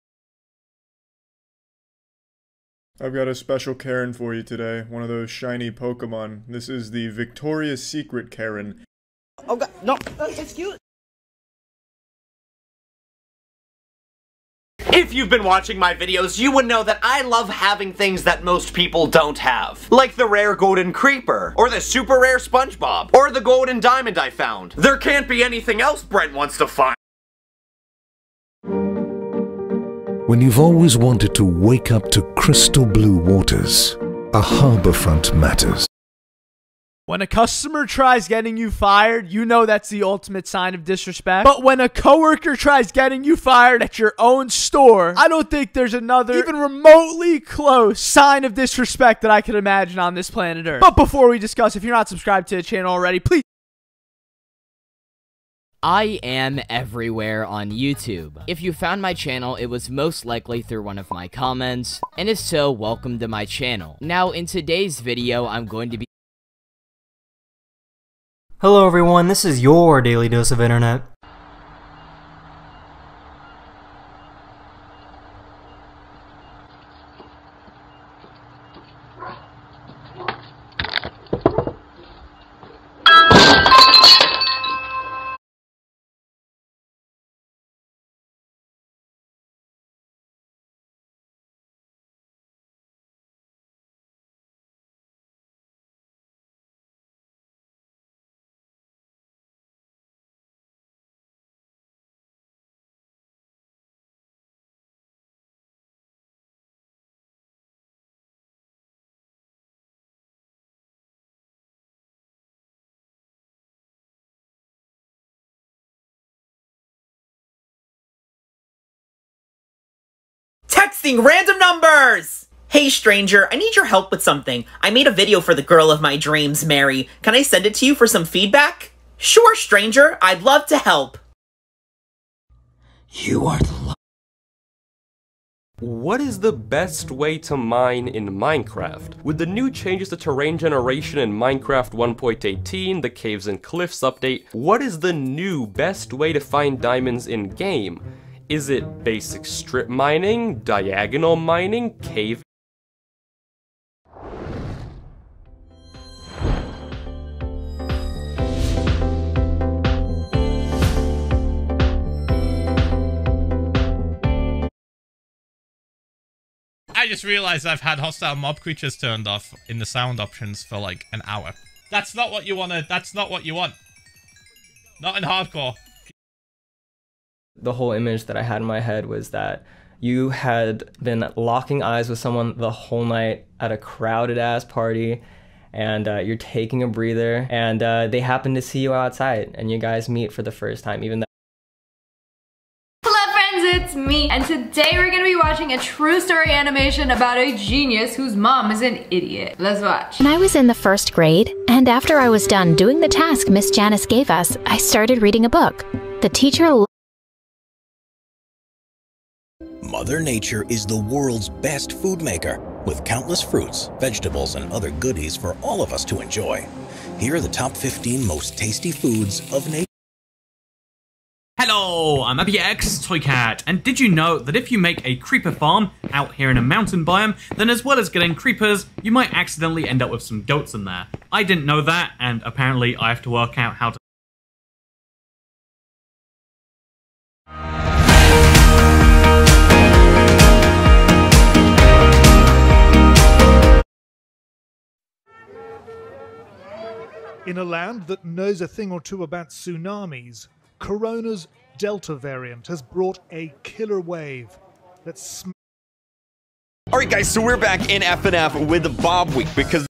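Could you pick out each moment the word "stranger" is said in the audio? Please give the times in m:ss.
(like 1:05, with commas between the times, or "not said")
2:02, 2:09.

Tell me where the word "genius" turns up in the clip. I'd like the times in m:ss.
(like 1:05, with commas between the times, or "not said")
3:17.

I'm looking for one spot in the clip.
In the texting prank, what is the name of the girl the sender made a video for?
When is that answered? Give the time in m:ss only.
2:06.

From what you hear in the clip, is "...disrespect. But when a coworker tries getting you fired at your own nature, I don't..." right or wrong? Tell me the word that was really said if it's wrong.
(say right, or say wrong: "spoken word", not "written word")
wrong: "store", not "nature".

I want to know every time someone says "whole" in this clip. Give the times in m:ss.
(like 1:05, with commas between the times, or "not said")
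2:57, 3:02.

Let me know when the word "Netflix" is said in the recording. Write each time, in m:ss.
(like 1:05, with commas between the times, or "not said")
not said.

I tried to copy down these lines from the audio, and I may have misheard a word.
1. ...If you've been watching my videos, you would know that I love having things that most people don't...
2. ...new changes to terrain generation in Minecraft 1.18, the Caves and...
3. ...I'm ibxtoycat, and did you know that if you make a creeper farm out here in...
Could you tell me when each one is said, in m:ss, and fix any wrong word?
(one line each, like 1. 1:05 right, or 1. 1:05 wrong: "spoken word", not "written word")
1. 0:14 right
2. 2:19 right
3. 3:42 right.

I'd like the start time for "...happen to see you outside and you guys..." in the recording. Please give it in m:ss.
3:08.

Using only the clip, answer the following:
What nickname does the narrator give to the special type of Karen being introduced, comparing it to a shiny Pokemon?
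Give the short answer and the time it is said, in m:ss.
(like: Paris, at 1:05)
Victoria's Secret Karen, at 0:07.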